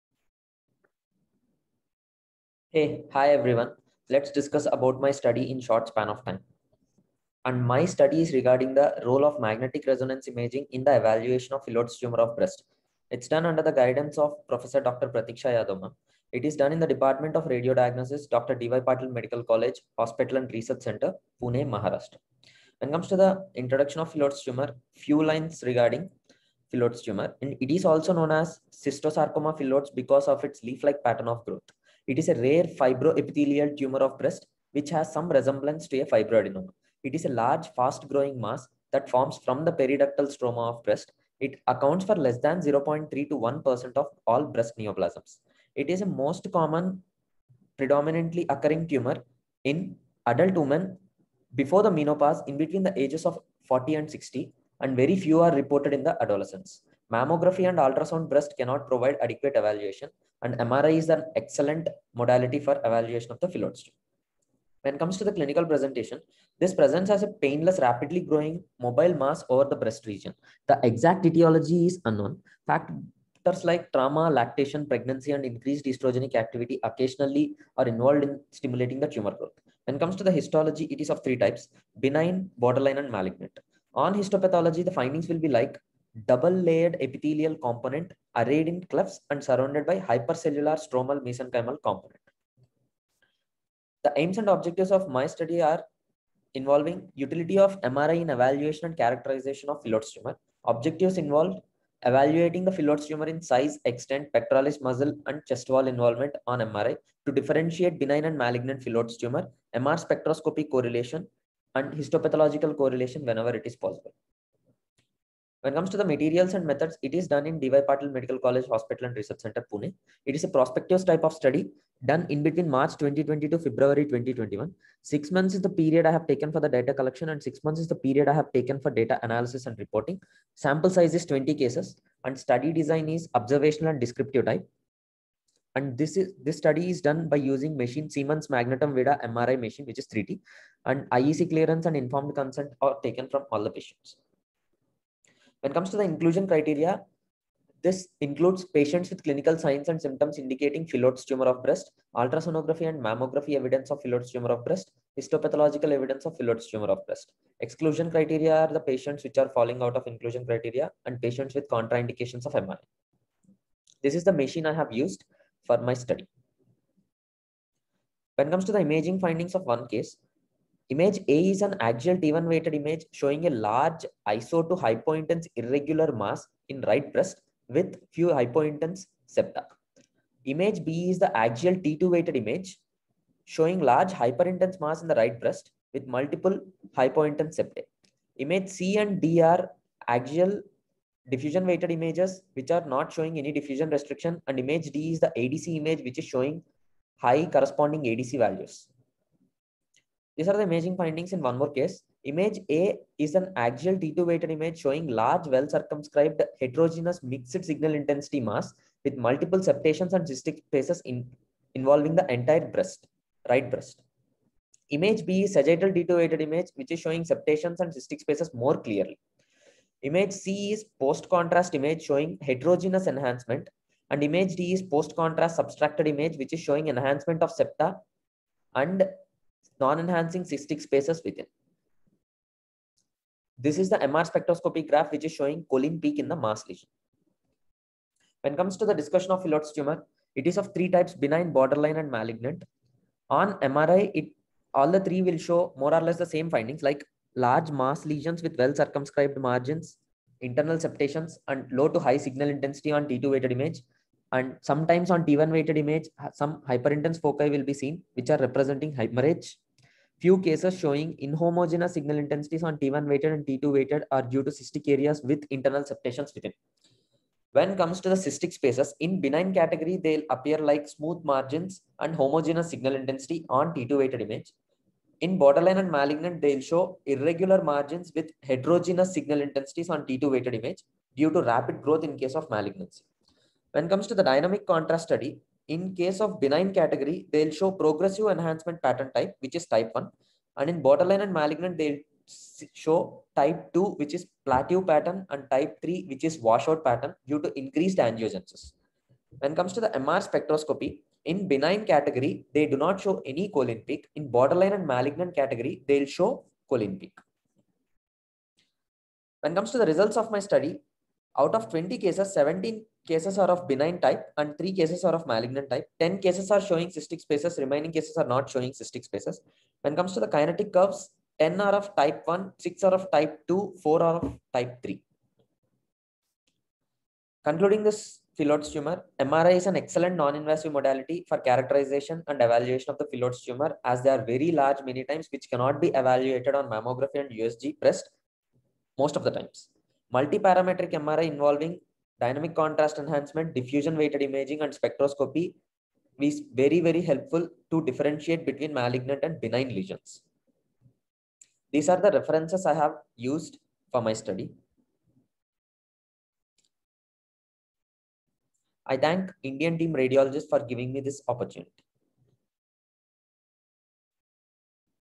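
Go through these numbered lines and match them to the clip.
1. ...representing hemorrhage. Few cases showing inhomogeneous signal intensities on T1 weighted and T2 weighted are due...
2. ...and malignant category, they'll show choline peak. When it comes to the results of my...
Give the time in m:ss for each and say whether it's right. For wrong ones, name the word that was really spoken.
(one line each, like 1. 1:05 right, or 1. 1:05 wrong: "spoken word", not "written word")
1. 4:18 right
2. 5:04 right.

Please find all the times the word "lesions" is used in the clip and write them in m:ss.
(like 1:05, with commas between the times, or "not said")
3:56, 4:08, 5:49.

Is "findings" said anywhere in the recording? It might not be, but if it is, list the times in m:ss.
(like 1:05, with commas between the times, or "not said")
1:25, 2:49, 3:20, 4:06.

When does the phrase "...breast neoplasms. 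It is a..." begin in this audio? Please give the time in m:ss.
0:44.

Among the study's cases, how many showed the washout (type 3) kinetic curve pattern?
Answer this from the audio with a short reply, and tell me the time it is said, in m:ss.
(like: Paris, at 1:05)
4, at 5:23.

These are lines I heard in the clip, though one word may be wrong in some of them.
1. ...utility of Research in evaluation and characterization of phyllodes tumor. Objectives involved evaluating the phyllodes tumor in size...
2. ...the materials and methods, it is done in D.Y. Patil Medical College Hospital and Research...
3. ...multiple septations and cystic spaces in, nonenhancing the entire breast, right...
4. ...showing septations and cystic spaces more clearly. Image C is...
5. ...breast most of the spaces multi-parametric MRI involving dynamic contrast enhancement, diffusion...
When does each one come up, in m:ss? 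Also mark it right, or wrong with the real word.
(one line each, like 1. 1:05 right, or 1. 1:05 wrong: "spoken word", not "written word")
1. 1:37 wrong: "MRI", not "Research"
2. 1:55 right
3. 3:29 wrong: "involving", not "nonenhancing"
4. 3:36 right
5. 5:37 wrong: "times", not "spaces".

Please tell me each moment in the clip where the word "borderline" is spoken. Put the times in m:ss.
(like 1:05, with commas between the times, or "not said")
1:22, 4:01, 4:35, 4:50, 5:04.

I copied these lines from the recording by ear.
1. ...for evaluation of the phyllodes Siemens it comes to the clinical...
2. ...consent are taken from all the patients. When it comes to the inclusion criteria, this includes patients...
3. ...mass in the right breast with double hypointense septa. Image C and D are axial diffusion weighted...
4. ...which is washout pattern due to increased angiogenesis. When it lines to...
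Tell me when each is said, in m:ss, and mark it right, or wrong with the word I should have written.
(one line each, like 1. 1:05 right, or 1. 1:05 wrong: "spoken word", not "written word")
1. 1:02 wrong: "When", not "Siemens"
2. 2:22 right
3. 3:04 wrong: "multiple", not "double"
4. 4:56 wrong: "comes", not "lines".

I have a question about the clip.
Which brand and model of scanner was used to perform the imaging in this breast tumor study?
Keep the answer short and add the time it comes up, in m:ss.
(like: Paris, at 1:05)
Siemens Magnetom Vida, at 2:18.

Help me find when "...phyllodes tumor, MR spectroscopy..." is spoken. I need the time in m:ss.
1:48.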